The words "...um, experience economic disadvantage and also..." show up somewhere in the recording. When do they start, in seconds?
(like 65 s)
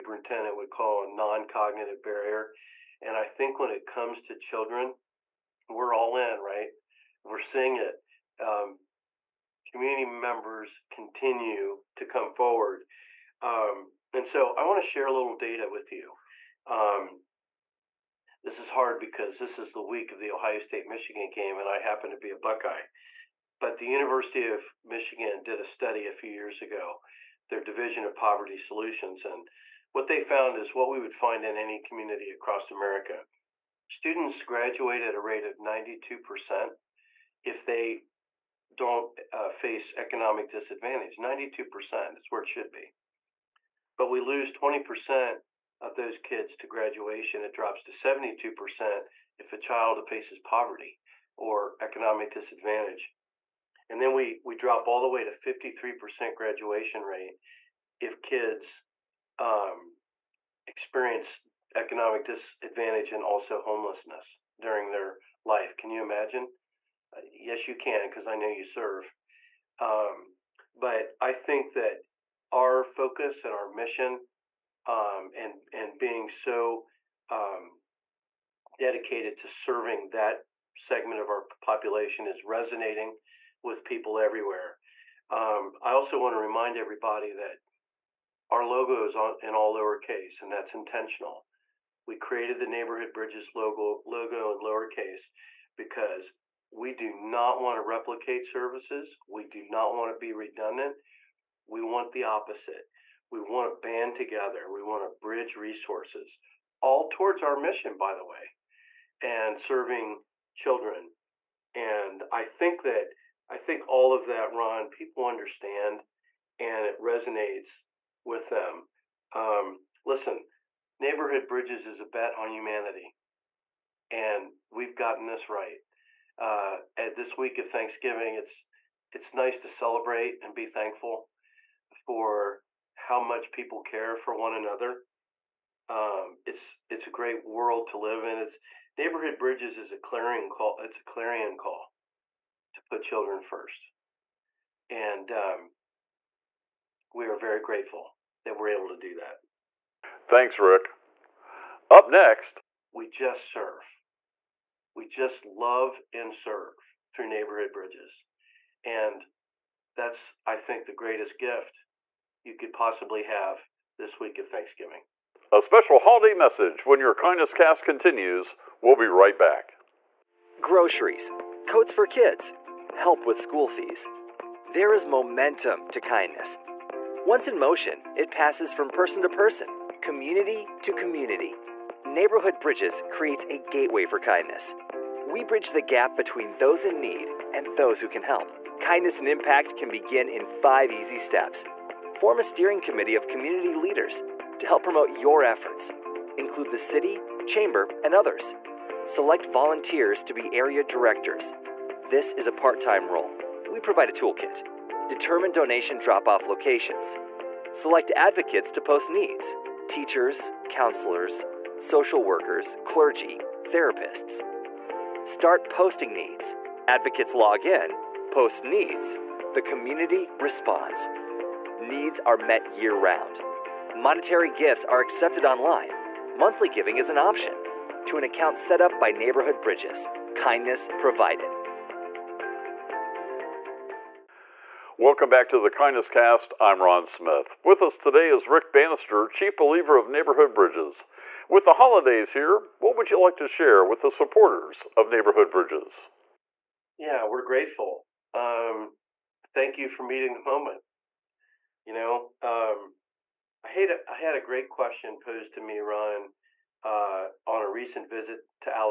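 59 s.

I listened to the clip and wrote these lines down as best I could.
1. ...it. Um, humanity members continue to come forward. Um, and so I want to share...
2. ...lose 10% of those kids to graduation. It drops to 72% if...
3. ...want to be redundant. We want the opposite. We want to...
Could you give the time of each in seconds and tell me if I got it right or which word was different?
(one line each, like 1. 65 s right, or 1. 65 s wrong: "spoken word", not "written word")
1. 7 s wrong: "community", not "humanity"
2. 44 s wrong: "20", not "10"
3. 99 s right.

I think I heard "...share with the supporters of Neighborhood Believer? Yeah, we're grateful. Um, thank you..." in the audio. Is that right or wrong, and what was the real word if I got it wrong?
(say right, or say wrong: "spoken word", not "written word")
wrong: "Bridges", not "Believer".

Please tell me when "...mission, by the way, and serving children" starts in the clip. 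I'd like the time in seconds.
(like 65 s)
107 s.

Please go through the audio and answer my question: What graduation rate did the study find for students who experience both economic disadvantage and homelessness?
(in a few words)
53%.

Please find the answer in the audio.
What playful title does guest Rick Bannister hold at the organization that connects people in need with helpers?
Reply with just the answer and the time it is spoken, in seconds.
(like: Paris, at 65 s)
Chief Believer, at 239 s.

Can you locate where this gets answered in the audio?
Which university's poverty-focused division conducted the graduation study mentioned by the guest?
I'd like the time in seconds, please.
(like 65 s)
23 s.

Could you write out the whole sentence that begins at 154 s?
We just love and serve through neighborhood bridges.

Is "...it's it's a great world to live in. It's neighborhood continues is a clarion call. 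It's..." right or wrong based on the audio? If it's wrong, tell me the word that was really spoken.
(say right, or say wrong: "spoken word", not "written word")
wrong: "bridges", not "continues".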